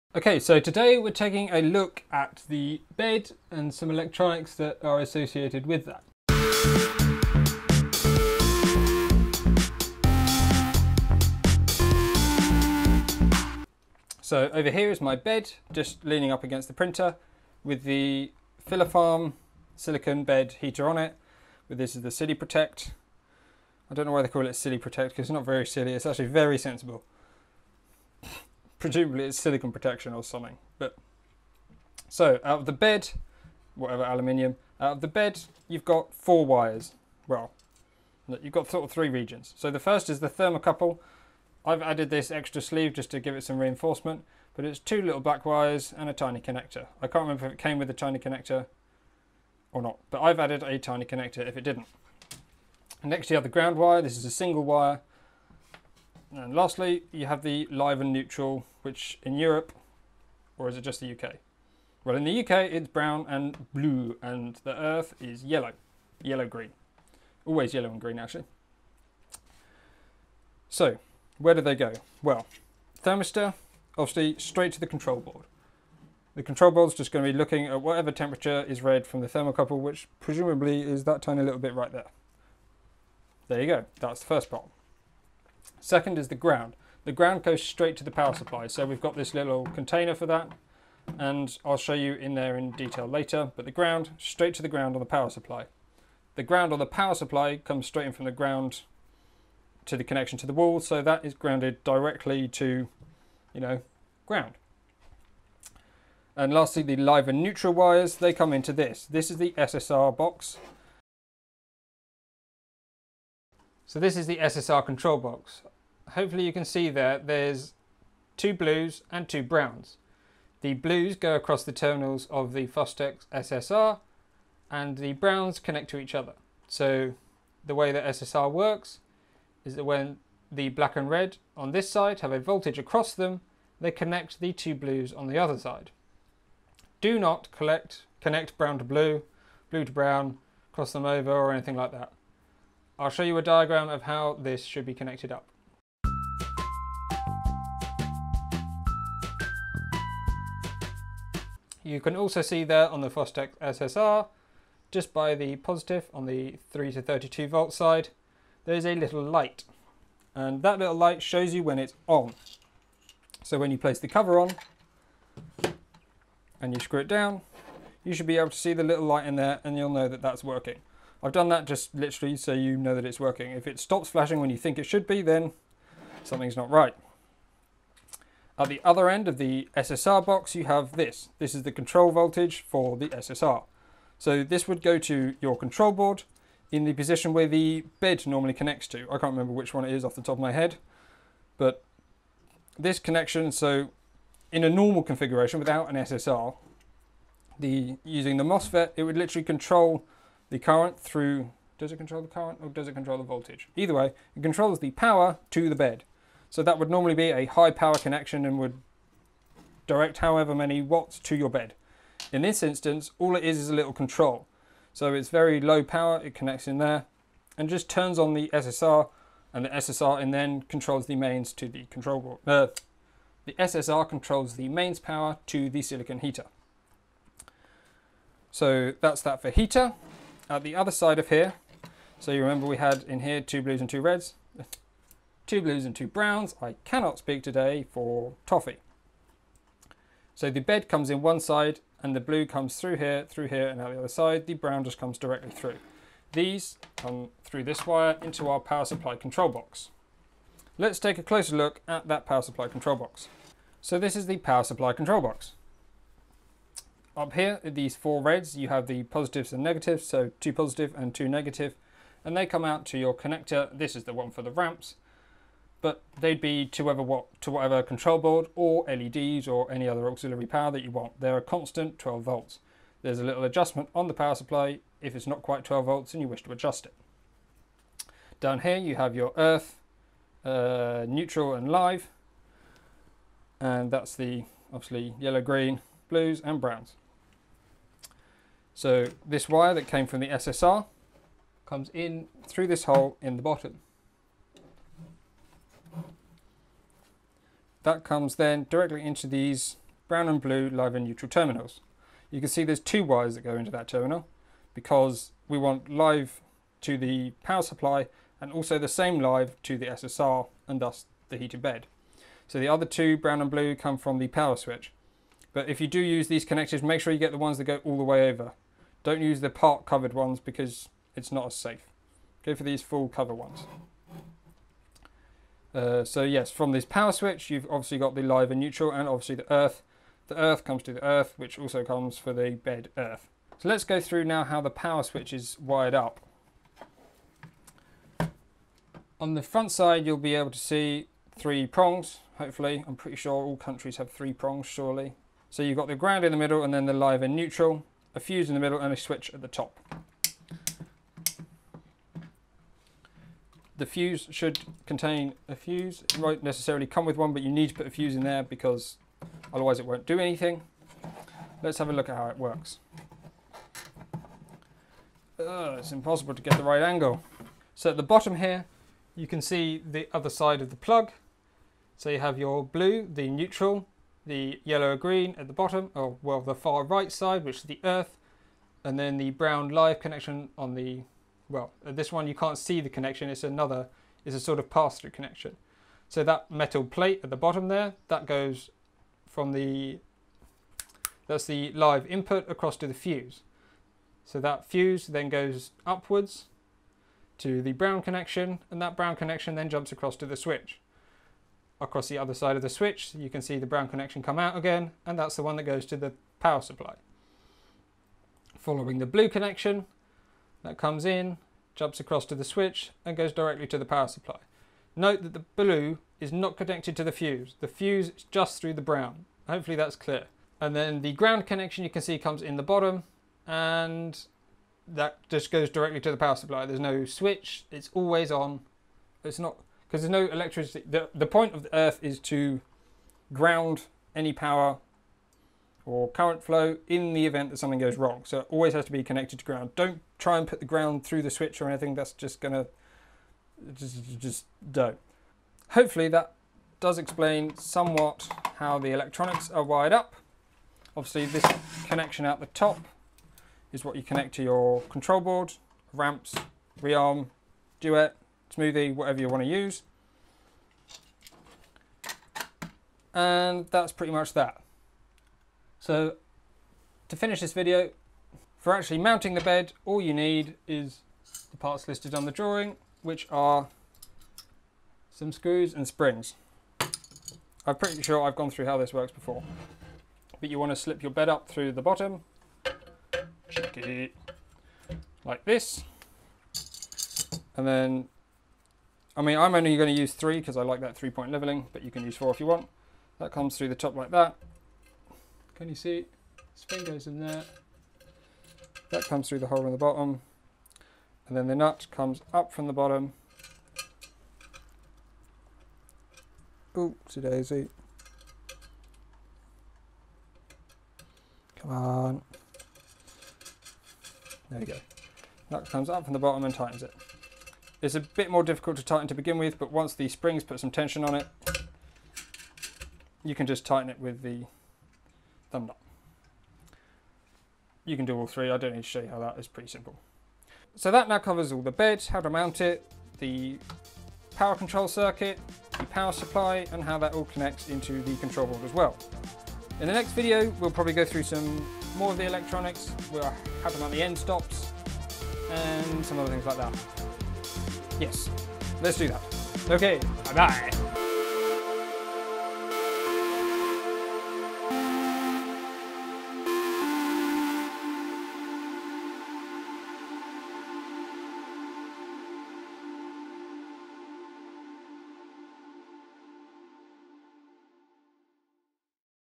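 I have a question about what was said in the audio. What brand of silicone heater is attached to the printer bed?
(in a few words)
Filafarm.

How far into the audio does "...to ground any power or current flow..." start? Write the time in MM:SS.
07:12.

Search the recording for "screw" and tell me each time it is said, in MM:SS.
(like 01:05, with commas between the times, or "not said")
02:46, 07:55.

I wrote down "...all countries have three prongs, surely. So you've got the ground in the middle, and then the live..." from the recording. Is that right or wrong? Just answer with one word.
right.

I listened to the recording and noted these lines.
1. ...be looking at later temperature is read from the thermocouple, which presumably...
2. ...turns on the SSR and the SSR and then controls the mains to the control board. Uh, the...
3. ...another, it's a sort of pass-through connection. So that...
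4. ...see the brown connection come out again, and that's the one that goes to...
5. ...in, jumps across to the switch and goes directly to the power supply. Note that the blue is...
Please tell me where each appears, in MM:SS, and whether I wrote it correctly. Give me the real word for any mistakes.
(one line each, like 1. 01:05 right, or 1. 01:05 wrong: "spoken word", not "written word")
1. 01:17 wrong: "whatever", not "later"
2. 03:37 right
3. 06:23 right
4. 06:43 right
5. 06:51 right.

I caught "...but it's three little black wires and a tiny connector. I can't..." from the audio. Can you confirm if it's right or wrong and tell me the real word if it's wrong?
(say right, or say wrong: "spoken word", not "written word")
wrong: "two", not "three".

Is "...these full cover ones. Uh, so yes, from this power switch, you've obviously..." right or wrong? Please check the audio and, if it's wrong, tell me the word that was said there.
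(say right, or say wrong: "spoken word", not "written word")
right.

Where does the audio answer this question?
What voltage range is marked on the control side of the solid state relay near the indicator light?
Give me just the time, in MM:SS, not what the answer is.
02:36.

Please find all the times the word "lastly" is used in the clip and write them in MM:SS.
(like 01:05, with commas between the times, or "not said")
00:56, 01:46.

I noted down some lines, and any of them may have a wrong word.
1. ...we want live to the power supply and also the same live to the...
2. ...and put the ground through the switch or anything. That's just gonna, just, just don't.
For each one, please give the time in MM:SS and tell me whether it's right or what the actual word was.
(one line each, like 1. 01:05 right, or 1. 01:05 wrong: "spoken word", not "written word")
1. 05:05 right
2. 07:20 right.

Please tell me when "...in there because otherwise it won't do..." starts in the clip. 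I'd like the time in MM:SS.
05:58.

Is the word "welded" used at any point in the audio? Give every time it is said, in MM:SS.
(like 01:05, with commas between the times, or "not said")
not said.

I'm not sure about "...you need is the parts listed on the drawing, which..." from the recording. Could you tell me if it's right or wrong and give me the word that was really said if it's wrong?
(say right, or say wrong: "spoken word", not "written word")
right.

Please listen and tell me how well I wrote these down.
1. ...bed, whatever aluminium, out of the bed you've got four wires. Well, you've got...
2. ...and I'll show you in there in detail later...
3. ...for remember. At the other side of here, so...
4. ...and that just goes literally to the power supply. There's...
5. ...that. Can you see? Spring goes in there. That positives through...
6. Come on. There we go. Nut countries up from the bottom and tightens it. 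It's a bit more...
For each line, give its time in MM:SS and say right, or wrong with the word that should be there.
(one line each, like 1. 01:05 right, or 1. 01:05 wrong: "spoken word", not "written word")
1. 00:32 right
2. 01:31 right
3. 03:49 wrong: "heater", not "remember"
4. 07:03 wrong: "directly", not "literally"
5. 08:14 wrong: "comes", not "positives"
6. 08:31 wrong: "comes", not "countries".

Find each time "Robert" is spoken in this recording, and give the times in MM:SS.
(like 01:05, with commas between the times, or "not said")
not said.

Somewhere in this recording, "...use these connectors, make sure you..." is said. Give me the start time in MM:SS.
05:15.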